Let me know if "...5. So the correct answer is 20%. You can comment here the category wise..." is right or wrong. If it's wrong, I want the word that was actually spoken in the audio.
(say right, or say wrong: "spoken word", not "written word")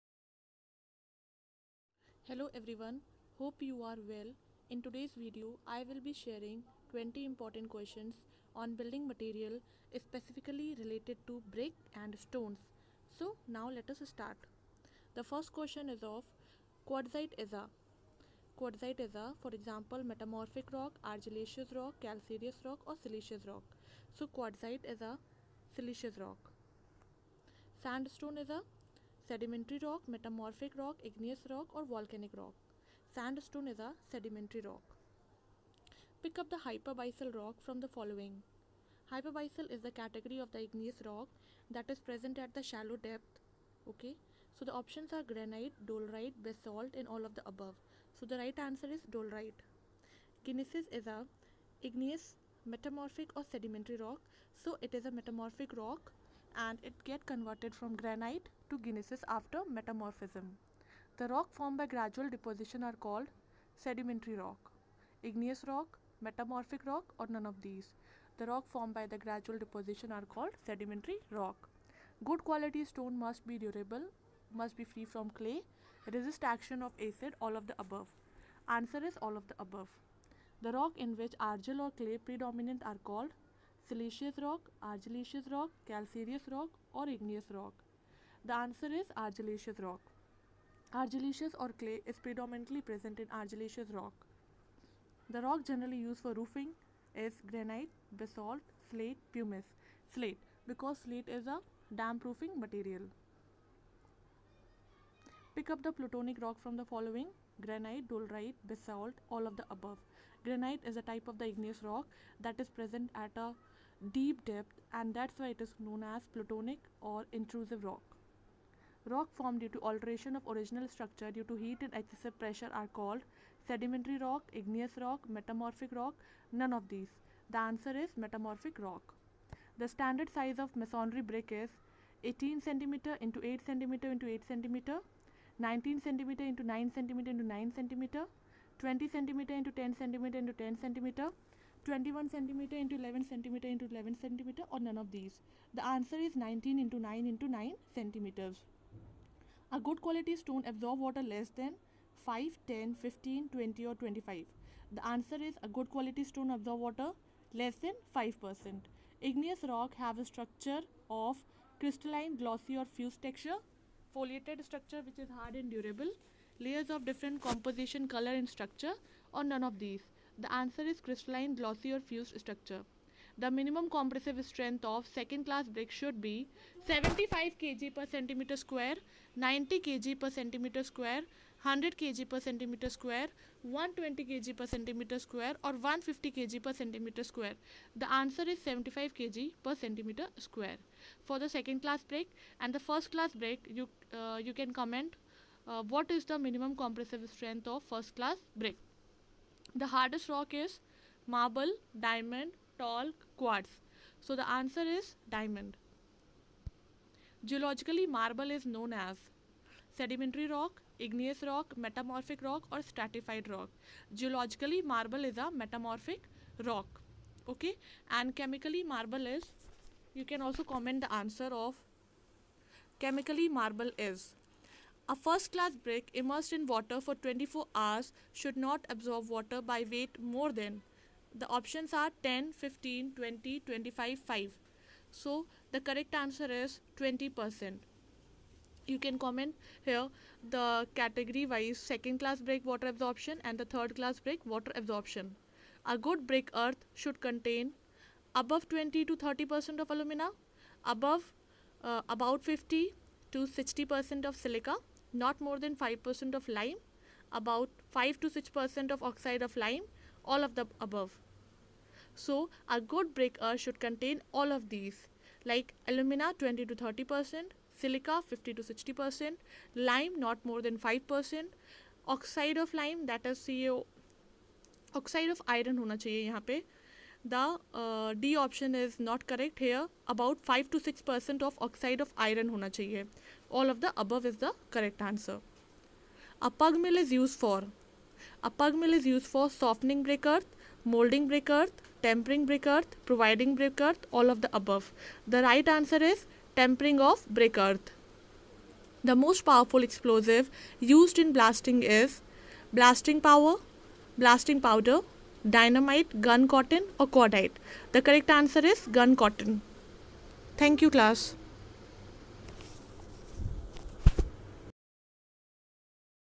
right.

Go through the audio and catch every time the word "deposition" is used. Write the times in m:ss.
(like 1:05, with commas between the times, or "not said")
1:02, 1:09.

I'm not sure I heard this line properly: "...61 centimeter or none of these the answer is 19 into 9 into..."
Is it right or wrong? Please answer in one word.
wrong.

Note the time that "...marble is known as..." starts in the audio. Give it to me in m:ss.
3:28.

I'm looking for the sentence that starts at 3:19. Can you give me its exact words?
The hardest rock is marble, diamond, talc, quartz.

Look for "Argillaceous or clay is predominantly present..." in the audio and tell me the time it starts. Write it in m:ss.
1:30.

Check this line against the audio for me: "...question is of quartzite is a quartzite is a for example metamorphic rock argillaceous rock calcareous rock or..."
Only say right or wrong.
right.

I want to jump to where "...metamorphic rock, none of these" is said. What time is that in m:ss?
2:05.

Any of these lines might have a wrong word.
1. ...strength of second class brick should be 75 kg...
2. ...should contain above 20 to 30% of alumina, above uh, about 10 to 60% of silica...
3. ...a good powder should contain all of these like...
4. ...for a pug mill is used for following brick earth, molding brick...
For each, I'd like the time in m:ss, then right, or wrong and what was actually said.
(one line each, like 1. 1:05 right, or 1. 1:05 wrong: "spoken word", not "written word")
1. 2:54 right
2. 4:06 wrong: "50", not "10"
3. 4:22 wrong: "breaker", not "powder"
4. 4:47 wrong: "softening", not "following".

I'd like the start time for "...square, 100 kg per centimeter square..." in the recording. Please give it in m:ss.
3:00.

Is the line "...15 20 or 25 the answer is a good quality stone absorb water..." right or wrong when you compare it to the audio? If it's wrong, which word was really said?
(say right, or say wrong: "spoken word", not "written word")
right.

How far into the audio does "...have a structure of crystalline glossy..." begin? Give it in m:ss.
2:40.